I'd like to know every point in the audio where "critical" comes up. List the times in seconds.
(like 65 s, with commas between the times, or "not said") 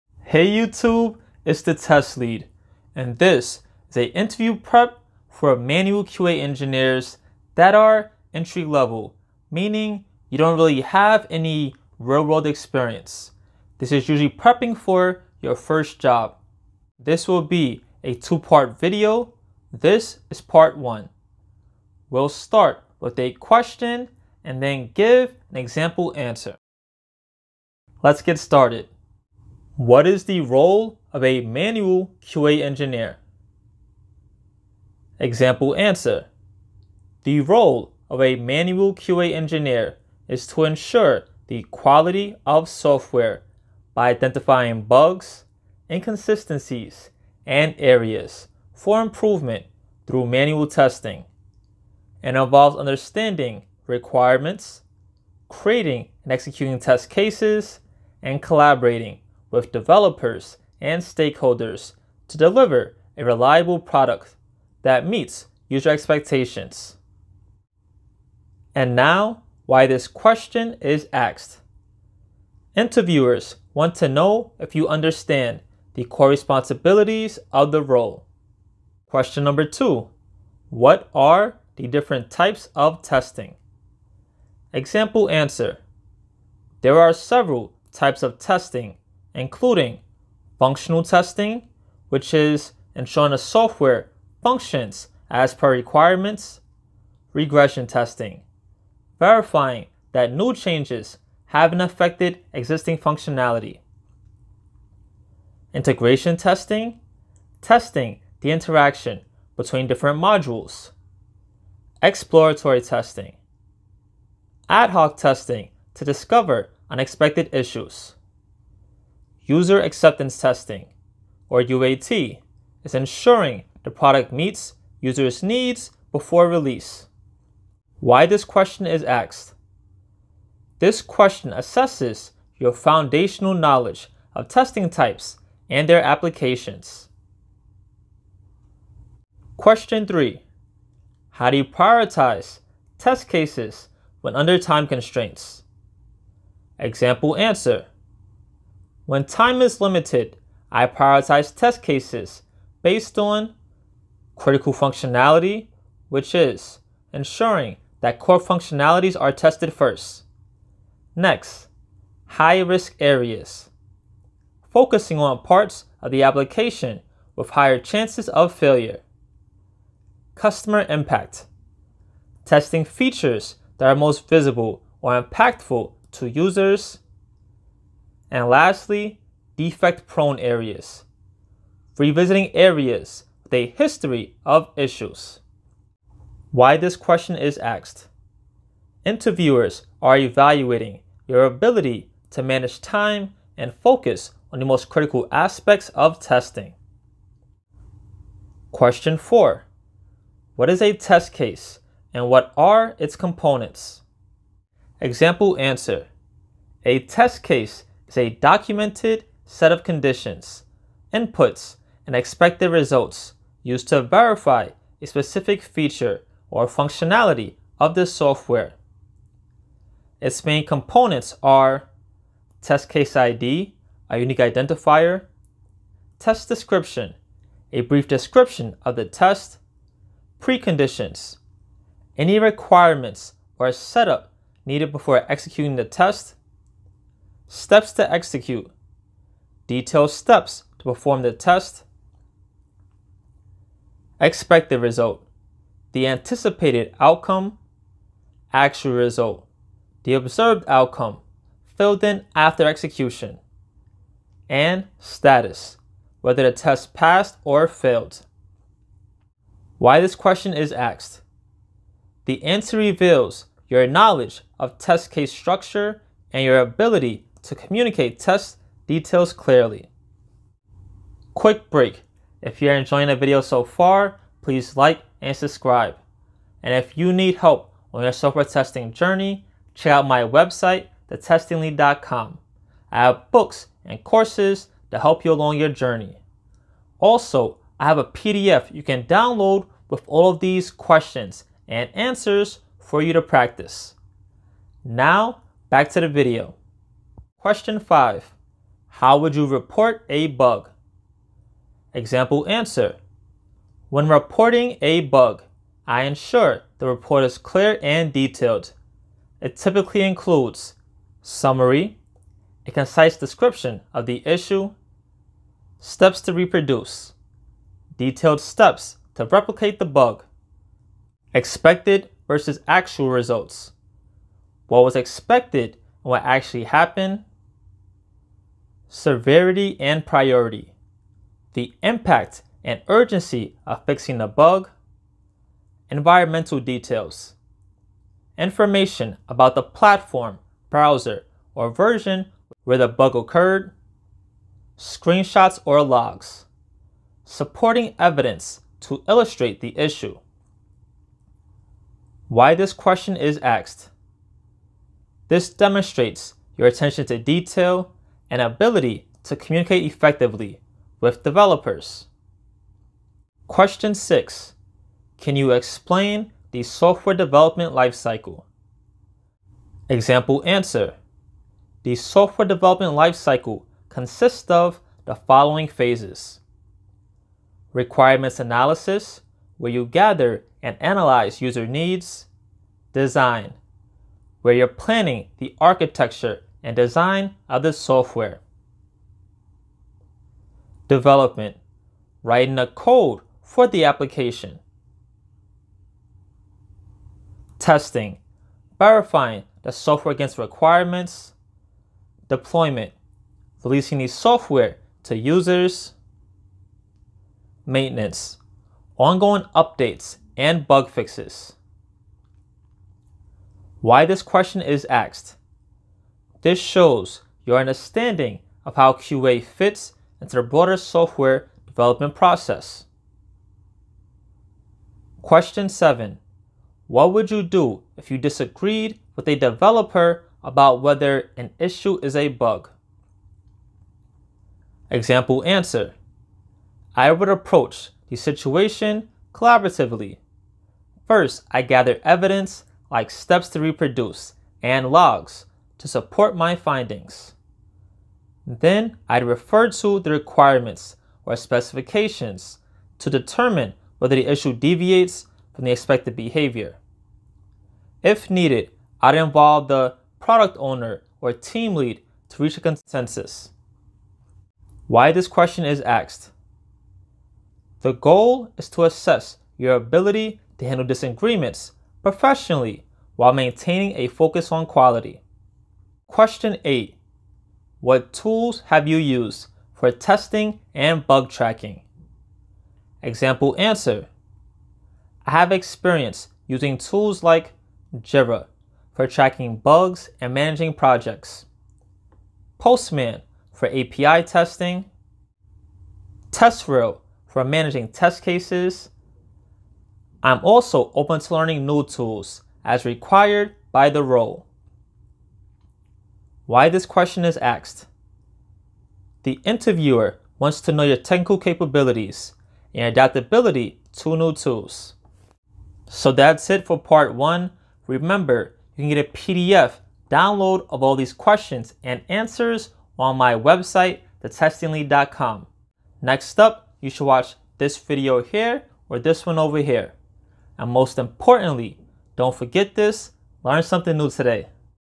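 154 s, 194 s.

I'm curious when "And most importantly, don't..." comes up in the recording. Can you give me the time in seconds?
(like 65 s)
530 s.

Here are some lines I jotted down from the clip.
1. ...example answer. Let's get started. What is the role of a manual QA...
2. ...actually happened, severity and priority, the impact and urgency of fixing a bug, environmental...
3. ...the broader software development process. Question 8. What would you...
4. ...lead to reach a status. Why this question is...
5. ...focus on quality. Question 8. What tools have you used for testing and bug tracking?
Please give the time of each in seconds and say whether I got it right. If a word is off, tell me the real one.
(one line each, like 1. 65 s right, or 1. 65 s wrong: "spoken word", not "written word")
1. 25 s right
2. 326 s right
3. 420 s wrong: "7", not "8"
4. 461 s wrong: "consensus", not "status"
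5. 474 s right.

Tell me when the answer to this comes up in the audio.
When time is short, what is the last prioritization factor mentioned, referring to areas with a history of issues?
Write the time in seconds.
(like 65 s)
179 s.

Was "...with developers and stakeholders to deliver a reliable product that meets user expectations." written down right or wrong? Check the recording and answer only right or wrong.
right.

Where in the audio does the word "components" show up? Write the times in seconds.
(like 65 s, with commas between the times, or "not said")
203 s, 220 s.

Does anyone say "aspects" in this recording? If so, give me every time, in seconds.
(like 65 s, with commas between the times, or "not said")
195 s.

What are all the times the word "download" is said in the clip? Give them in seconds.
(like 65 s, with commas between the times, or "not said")
289 s, 520 s.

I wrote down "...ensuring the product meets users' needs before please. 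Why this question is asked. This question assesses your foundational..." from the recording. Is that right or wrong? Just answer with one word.
wrong.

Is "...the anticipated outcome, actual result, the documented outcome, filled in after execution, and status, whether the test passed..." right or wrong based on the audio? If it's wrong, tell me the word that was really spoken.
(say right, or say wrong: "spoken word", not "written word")
wrong: "observed", not "documented".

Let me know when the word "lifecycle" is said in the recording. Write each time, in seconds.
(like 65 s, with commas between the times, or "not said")
367 s, 372 s.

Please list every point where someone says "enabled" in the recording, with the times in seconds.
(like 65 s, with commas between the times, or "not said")
not said.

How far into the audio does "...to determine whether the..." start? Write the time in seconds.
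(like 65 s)
452 s.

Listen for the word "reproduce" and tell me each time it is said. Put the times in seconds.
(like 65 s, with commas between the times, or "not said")
316 s, 443 s.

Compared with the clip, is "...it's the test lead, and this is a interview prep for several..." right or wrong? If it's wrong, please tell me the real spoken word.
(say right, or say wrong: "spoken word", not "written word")
wrong: "manual", not "several".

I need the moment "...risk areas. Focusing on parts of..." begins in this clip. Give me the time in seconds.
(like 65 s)
162 s.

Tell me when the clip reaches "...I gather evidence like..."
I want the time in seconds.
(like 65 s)
441 s.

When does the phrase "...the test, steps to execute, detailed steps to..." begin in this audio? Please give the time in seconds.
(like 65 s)
235 s.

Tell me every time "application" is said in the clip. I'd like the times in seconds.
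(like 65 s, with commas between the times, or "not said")
136 s, 166 s, 393 s.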